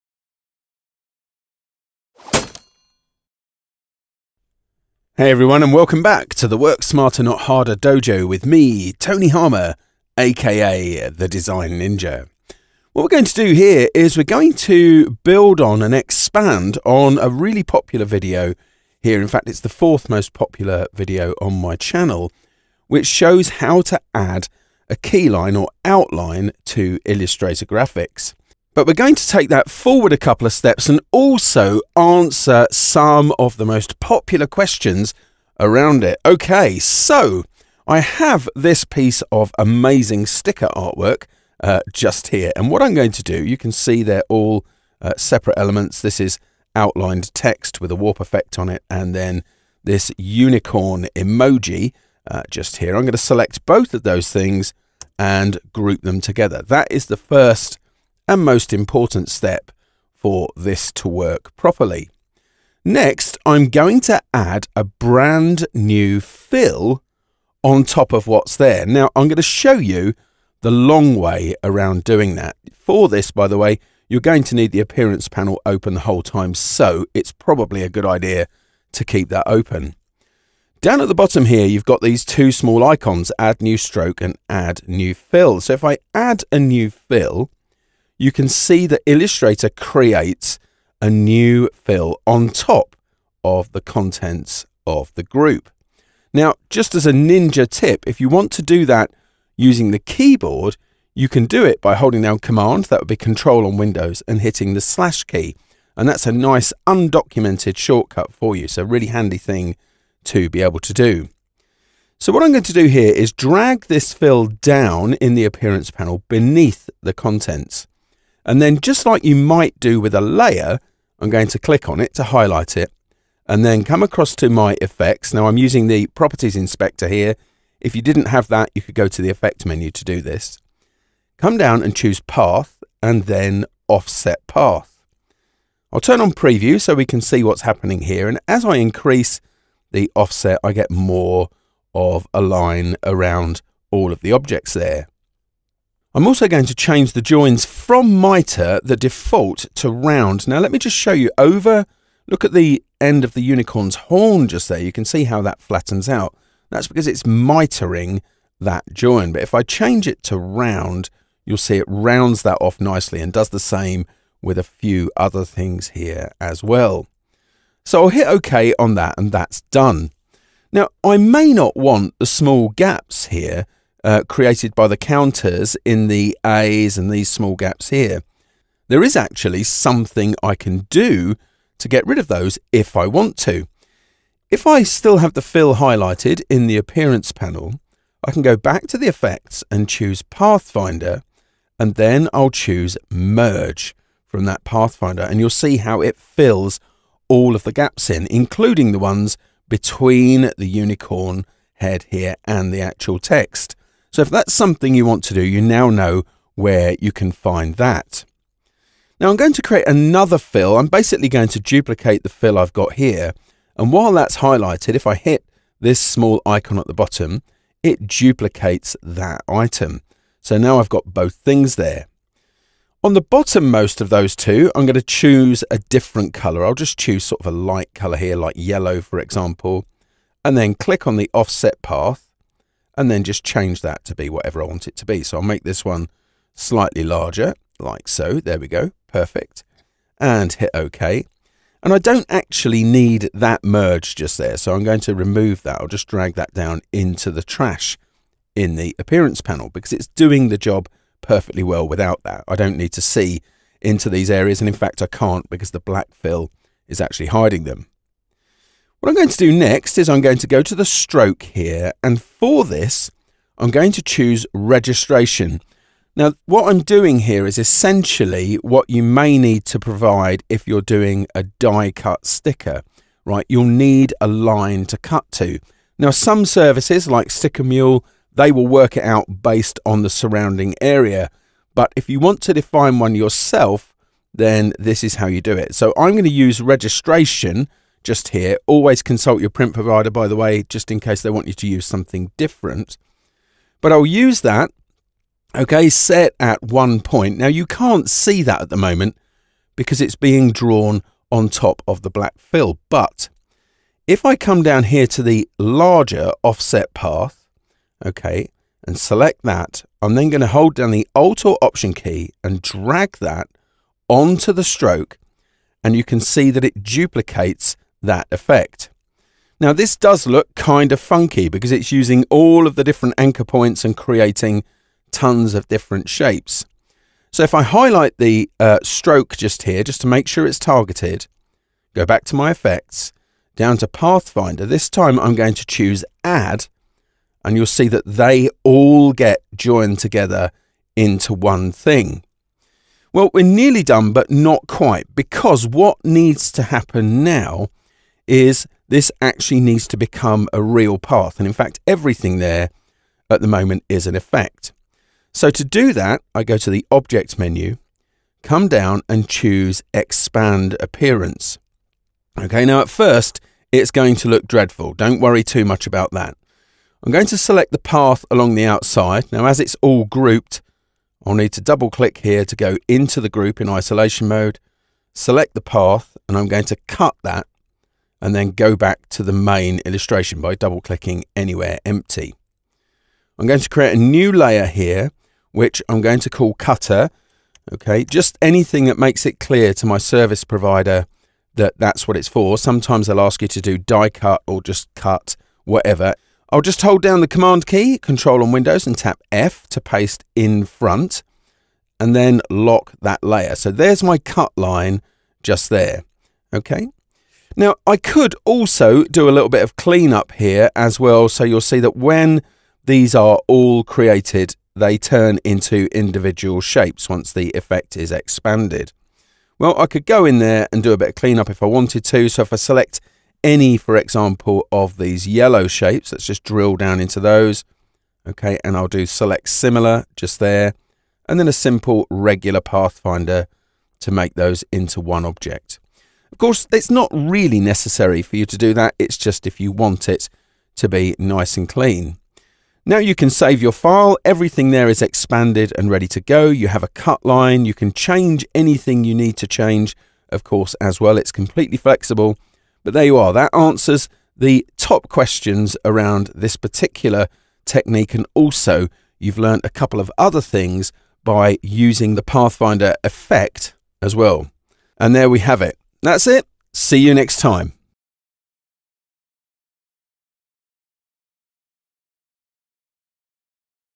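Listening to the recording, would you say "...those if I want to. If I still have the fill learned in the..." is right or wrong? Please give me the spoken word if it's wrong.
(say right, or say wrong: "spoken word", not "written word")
wrong: "highlighted", not "learned".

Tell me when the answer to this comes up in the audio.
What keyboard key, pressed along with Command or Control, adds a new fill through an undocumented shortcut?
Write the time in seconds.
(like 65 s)
104 s.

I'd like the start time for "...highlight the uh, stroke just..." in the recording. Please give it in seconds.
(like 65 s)
327 s.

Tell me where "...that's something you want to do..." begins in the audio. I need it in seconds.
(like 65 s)
204 s.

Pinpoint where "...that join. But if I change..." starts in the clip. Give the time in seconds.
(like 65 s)
158 s.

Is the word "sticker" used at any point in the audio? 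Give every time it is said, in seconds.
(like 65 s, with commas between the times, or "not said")
40 s, 272 s, 277 s.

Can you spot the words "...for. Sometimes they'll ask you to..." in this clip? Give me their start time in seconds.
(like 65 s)
392 s.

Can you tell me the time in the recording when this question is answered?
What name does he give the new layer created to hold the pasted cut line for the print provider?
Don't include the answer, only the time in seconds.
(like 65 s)
386 s.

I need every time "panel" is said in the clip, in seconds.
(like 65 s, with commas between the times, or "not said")
75 s, 115 s, 187 s, 249 s.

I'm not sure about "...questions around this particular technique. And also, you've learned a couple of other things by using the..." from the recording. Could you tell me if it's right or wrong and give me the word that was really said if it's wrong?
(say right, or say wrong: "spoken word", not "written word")
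right.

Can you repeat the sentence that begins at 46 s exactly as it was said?
This is outlined text with a warp effect on it, and then this unicorn emoji uh, just here.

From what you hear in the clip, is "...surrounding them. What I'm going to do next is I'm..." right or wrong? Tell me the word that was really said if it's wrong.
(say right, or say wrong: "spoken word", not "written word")
wrong: "hiding", not "surrounding".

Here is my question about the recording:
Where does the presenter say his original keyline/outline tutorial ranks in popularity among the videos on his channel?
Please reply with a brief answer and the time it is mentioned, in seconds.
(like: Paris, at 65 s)
fourth most popular, at 19 s.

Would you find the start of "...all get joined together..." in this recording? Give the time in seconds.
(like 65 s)
338 s.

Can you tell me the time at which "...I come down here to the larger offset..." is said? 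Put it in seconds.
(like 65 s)
304 s.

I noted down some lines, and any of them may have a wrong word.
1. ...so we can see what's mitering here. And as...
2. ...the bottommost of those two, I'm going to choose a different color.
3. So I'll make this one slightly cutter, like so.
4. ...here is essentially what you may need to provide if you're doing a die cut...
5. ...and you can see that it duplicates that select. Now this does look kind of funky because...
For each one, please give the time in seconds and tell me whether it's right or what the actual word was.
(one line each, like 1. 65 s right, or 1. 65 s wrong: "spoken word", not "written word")
1. 136 s wrong: "happening", not "mitering"
2. 223 s right
3. 235 s wrong: "larger", not "cutter"
4. 267 s right
5. 315 s wrong: "effect", not "select".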